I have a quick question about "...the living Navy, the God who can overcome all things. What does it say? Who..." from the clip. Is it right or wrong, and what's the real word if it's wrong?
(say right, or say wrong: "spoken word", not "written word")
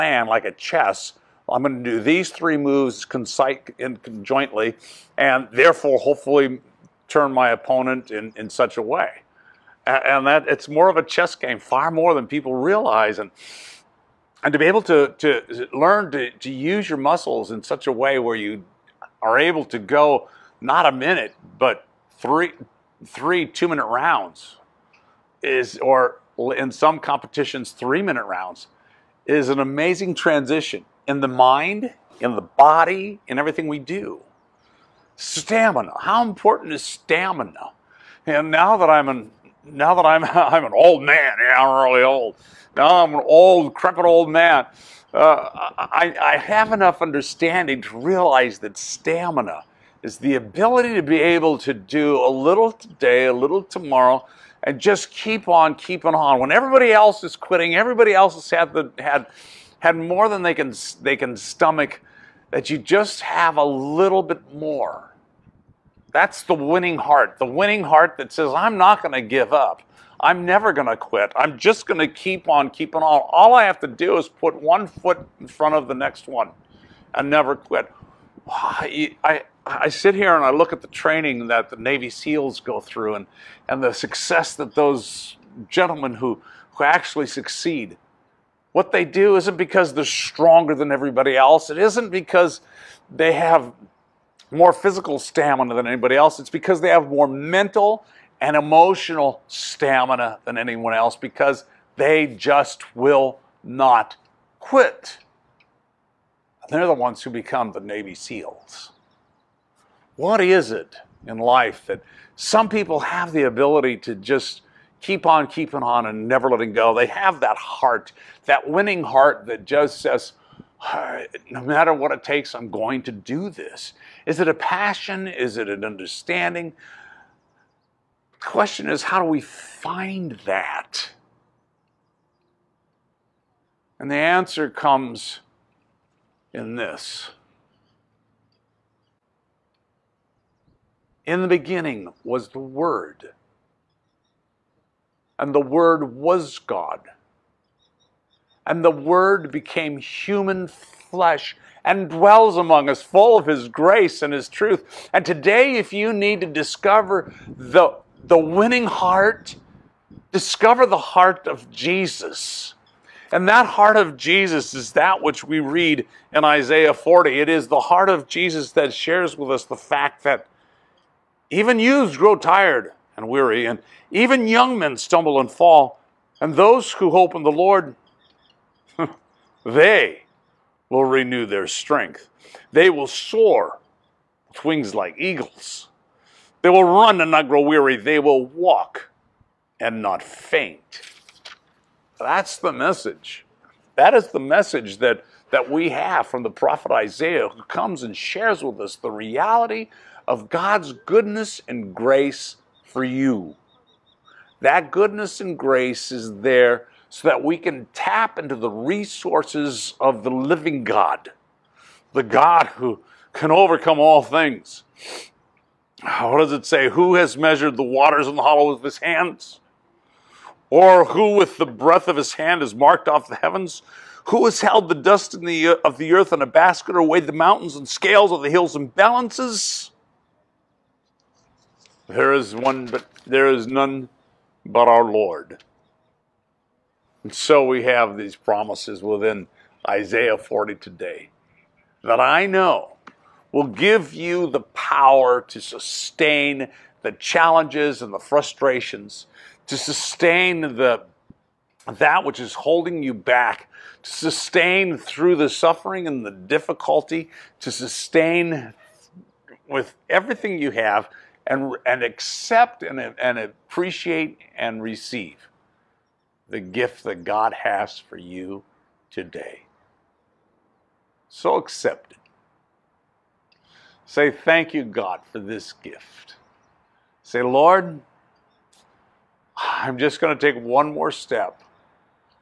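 wrong: "God", not "Navy".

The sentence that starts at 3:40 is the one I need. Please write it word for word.
Or who with the breath of his hand has marked off the heavens?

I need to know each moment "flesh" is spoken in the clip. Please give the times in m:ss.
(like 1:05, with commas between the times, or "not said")
2:30.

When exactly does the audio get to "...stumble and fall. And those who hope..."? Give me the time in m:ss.
2:54.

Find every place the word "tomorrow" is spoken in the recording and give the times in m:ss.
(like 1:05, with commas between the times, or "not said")
0:53.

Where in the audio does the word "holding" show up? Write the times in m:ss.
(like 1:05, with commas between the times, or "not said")
4:12.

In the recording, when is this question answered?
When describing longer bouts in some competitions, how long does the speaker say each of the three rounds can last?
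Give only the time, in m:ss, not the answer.
0:27.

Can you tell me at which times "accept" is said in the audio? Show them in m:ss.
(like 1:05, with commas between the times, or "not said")
4:22, 4:31.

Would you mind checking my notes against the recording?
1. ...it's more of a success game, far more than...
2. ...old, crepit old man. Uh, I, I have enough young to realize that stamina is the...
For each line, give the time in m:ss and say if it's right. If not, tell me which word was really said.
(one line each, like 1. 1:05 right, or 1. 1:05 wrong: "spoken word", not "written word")
1. 0:10 wrong: "chess", not "success"
2. 0:43 wrong: "understanding", not "young".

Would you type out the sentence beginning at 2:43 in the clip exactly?
And that heart of Jesus is that which we read in Isaiah 40.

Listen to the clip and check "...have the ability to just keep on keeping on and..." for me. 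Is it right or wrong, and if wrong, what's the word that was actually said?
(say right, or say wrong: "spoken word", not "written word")
right.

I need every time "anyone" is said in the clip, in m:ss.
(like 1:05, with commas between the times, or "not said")
1:40.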